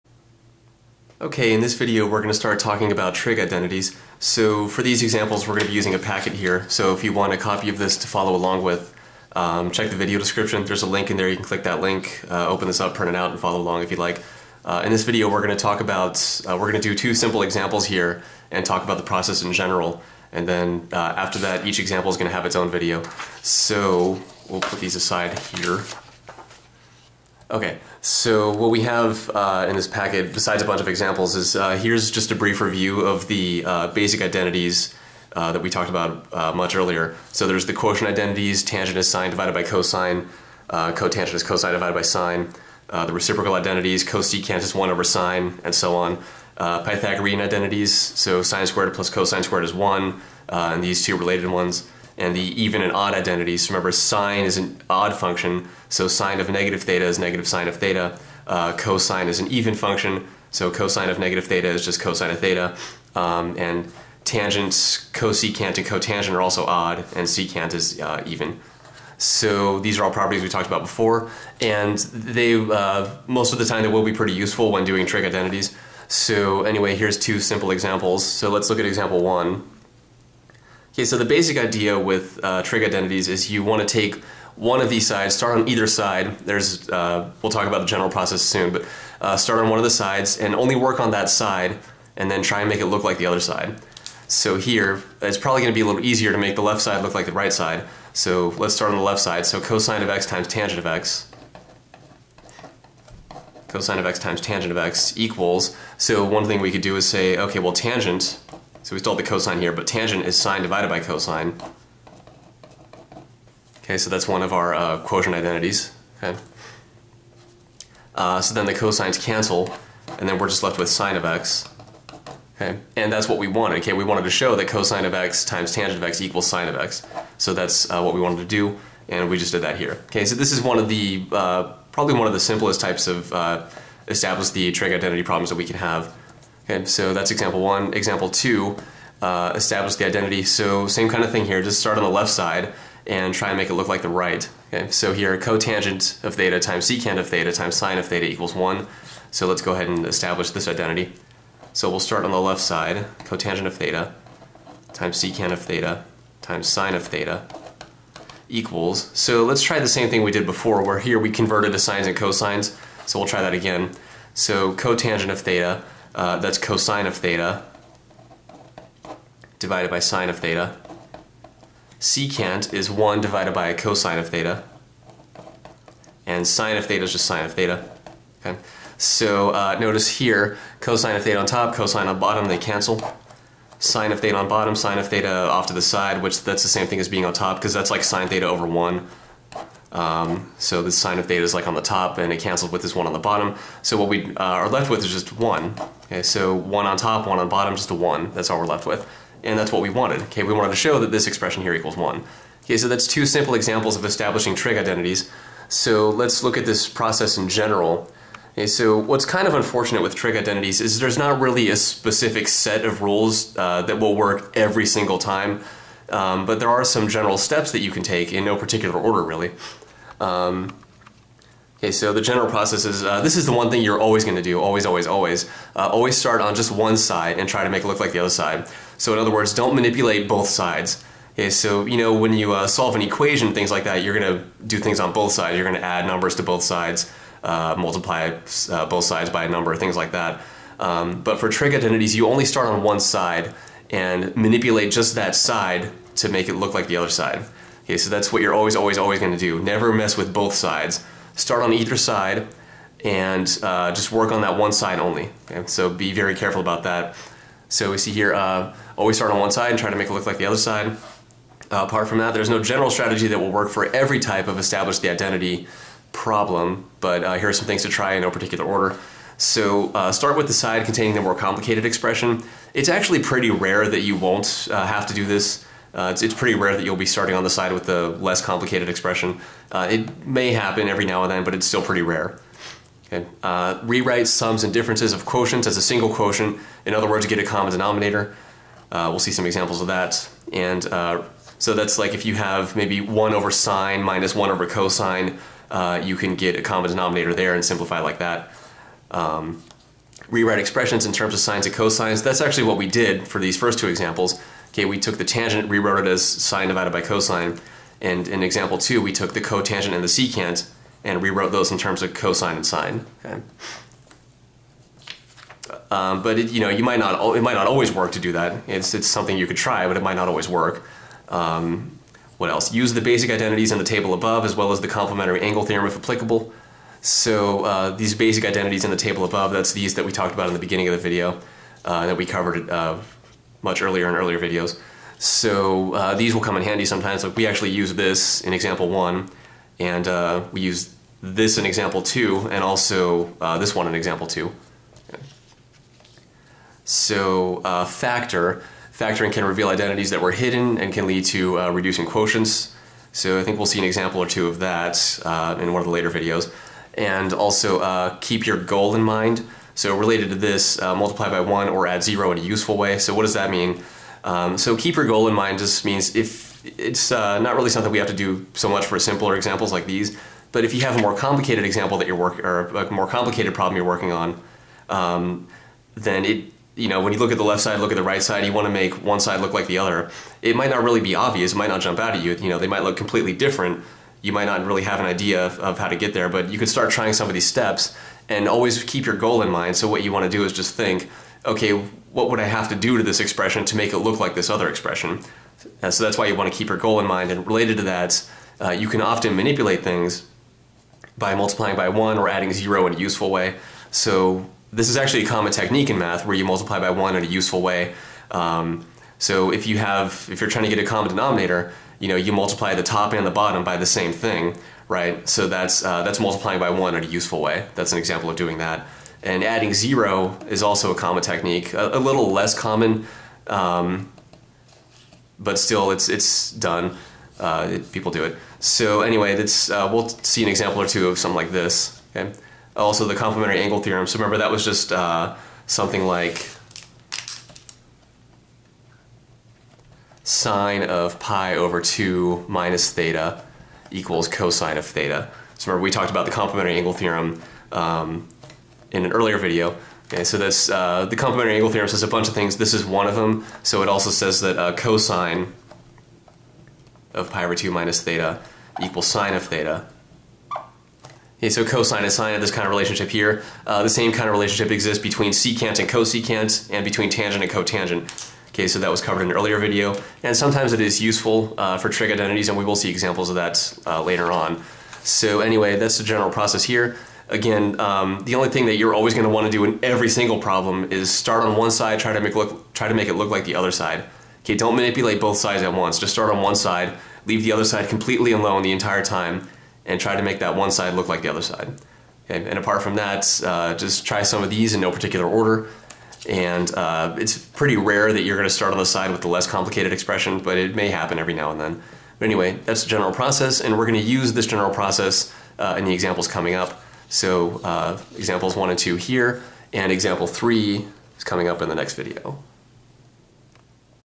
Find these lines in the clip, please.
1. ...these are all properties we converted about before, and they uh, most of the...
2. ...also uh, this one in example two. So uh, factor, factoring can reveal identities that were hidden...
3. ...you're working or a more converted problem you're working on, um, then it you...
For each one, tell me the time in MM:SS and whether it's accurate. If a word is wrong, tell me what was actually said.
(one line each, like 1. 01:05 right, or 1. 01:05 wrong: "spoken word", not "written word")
1. 01:09 wrong: "talked", not "converted"
2. 05:42 right
3. 06:12 wrong: "complicated", not "converted".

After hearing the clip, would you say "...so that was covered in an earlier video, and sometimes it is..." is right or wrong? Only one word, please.
right.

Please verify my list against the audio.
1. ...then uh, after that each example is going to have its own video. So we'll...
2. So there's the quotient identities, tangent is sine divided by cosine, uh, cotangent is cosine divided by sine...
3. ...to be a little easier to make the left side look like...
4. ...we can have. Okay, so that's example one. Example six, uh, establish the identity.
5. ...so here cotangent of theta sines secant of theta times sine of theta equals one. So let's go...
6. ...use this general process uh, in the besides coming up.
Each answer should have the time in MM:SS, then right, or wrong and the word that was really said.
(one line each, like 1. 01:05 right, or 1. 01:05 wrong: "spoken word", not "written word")
1. 00:20 right
2. 00:37 right
3. 01:35 right
4. 02:15 wrong: "two", not "six"
5. 02:24 wrong: "times", not "sines"
6. 08:24 wrong: "examples", not "besides".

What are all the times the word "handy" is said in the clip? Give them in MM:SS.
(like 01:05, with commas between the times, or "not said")
05:36.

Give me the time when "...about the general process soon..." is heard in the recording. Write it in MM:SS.
01:27.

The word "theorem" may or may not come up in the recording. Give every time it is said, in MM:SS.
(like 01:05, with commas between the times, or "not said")
05:25, 07:13, 07:26, 07:31.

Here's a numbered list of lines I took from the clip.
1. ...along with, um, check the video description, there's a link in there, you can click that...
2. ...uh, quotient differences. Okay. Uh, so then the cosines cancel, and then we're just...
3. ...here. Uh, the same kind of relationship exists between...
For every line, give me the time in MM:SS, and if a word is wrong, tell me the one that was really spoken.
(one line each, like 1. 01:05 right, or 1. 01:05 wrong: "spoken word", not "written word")
1. 00:08 right
2. 01:54 wrong: "identities", not "differences"
3. 07:43 right.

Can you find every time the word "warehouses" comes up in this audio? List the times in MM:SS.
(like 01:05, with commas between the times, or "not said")
not said.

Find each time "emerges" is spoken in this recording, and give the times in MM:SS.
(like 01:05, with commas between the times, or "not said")
not said.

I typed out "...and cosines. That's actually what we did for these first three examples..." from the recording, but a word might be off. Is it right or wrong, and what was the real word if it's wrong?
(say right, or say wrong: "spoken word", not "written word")
wrong: "two", not "three".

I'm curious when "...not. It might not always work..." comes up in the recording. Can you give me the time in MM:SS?
05:16.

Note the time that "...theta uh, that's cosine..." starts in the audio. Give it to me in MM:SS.
02:45.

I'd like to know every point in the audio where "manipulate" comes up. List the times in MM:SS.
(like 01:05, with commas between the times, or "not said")
03:49, 04:04, 06:39, 08:04.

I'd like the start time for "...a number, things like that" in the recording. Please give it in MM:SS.
03:59.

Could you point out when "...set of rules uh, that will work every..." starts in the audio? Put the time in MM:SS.
03:32.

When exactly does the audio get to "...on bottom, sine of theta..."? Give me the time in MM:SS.
03:04.